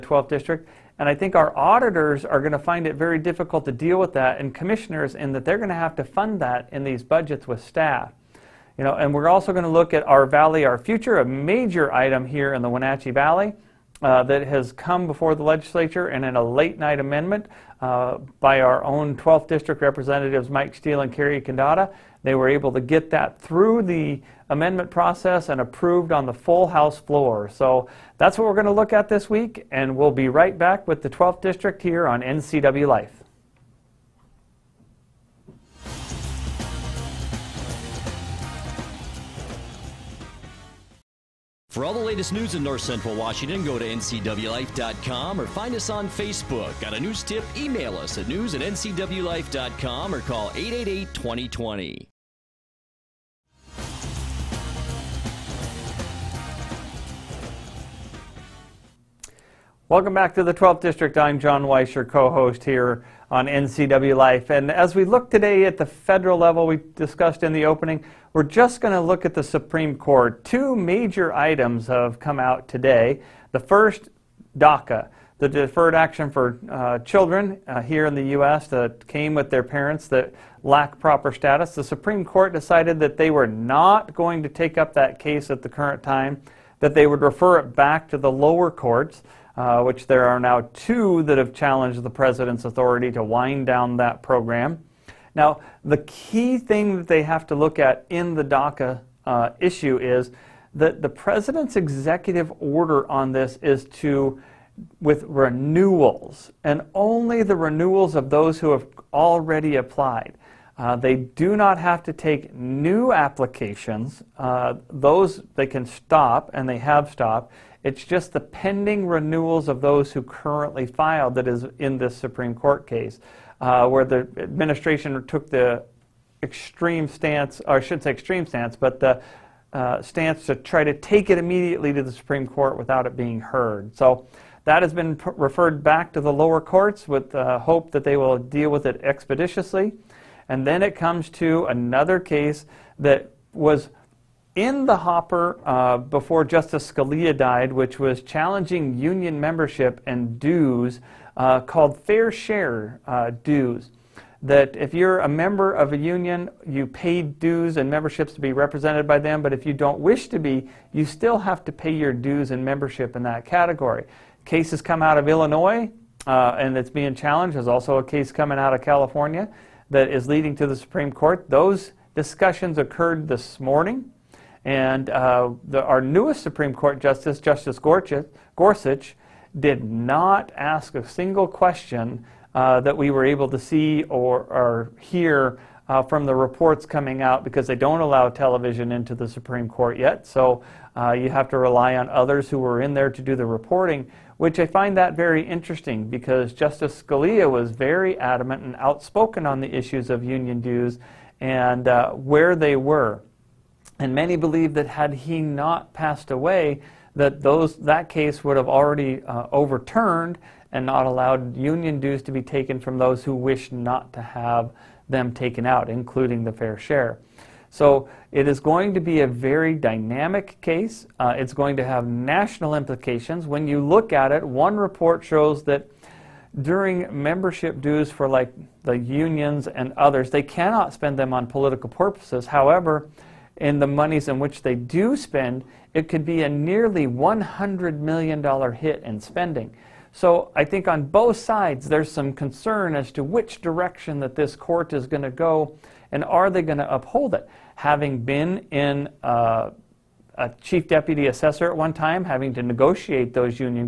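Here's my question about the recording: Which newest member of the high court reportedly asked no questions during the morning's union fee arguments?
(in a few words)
Justice Gorsuch.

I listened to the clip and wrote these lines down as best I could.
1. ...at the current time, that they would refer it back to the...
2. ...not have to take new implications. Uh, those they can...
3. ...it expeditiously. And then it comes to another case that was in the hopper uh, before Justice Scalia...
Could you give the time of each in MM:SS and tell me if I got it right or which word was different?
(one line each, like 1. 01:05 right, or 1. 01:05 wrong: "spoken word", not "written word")
1. 01:25 right
2. 01:51 wrong: "applications", not "implications"
3. 02:18 right.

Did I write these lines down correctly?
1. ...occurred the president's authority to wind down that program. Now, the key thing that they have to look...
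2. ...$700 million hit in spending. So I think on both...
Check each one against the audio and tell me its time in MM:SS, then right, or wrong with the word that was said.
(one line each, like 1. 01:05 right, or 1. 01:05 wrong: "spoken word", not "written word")
1. 01:31 wrong: "challenged", not "occurred"
2. 03:57 wrong: "100", not "700".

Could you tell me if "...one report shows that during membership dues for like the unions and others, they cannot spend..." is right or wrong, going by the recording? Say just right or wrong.
right.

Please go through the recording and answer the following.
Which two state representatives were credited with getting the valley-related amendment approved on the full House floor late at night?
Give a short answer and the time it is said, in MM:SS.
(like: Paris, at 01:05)
Mike Steele and Cary Condotta, at 00:20.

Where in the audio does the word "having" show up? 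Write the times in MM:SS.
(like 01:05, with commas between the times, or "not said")
04:07, 04:12.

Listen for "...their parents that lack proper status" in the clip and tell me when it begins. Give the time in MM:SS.
01:19.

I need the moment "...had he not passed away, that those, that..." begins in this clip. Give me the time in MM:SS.
03:24.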